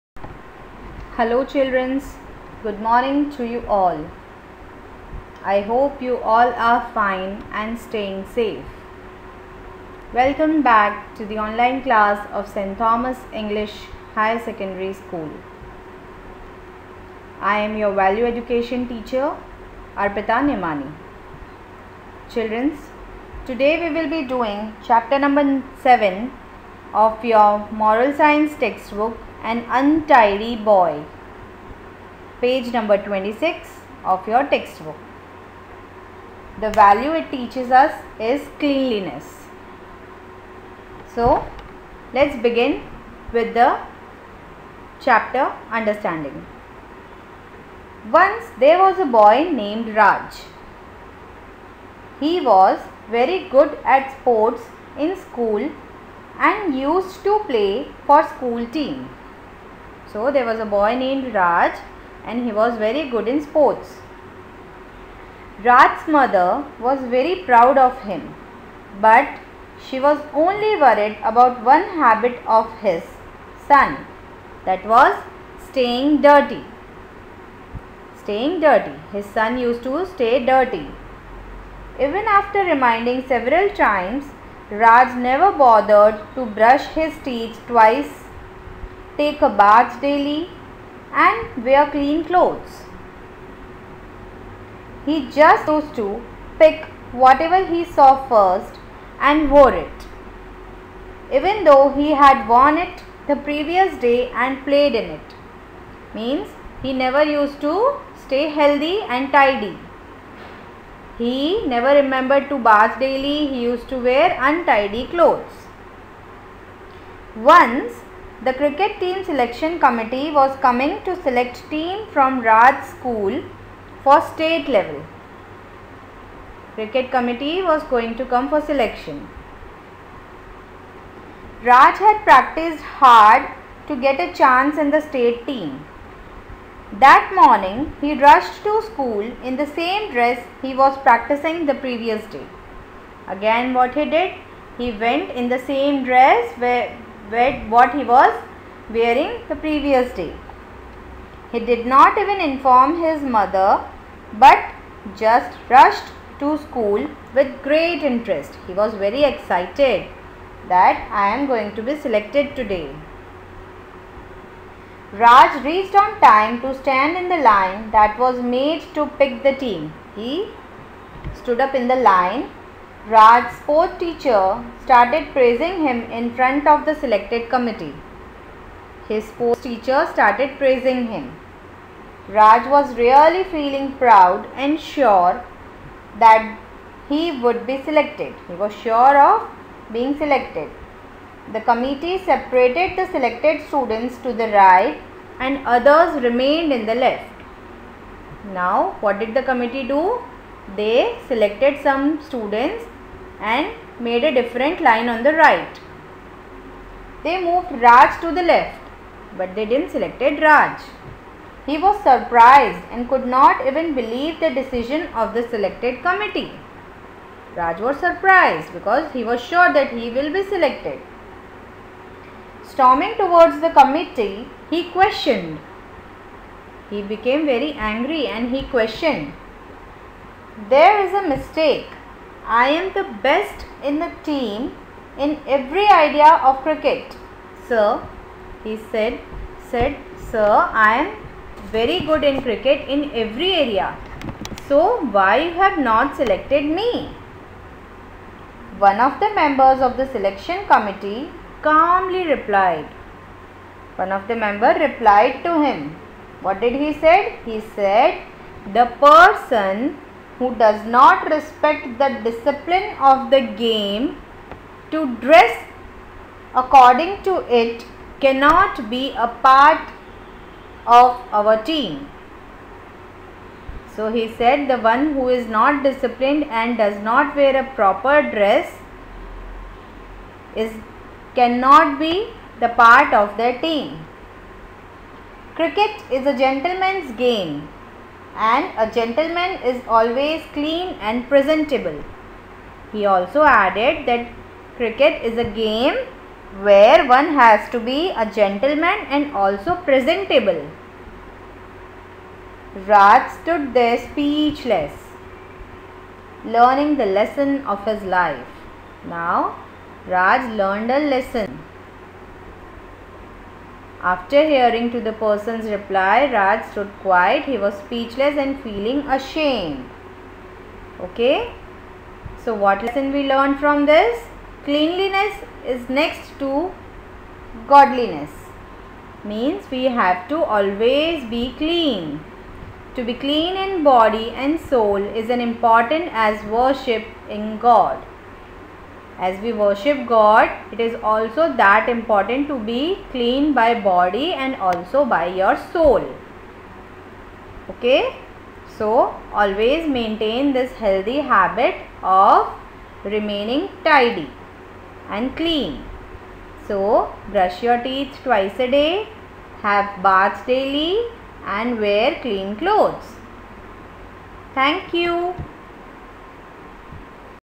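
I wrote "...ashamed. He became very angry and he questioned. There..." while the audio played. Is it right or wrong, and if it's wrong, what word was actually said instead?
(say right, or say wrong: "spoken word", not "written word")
wrong: "questioned", not "ashamed".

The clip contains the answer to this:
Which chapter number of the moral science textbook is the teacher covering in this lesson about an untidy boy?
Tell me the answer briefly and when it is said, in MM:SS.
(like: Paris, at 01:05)
7, at 00:24.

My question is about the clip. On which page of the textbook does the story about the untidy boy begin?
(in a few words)
26.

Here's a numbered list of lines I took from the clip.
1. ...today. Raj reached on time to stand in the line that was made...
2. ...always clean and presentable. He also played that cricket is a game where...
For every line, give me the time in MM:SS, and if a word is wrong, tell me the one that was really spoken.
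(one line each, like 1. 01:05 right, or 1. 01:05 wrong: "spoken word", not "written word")
1. 02:42 right
2. 04:49 wrong: "added", not "played".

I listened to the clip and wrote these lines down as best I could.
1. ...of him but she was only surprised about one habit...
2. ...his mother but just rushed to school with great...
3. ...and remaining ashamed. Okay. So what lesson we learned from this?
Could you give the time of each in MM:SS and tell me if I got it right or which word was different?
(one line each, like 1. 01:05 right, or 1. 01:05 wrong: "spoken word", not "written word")
1. 01:07 wrong: "worried", not "surprised"
2. 02:33 right
3. 05:18 wrong: "feeling", not "remaining".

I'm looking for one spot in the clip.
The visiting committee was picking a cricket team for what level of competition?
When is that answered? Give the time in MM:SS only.
02:04.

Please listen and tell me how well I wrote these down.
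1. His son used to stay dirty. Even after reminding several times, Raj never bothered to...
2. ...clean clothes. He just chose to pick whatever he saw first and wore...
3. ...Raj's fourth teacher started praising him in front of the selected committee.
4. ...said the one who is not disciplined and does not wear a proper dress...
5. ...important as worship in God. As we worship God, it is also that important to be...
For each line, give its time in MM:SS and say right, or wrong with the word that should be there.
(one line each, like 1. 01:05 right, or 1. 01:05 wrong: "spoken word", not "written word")
1. 01:19 right
2. 01:31 right
3. 02:53 right
4. 04:34 right
5. 05:35 right.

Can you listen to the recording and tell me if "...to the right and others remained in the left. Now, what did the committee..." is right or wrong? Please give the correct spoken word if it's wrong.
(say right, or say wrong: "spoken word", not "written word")
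right.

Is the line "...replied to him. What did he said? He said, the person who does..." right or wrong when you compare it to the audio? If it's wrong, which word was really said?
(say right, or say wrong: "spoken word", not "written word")
right.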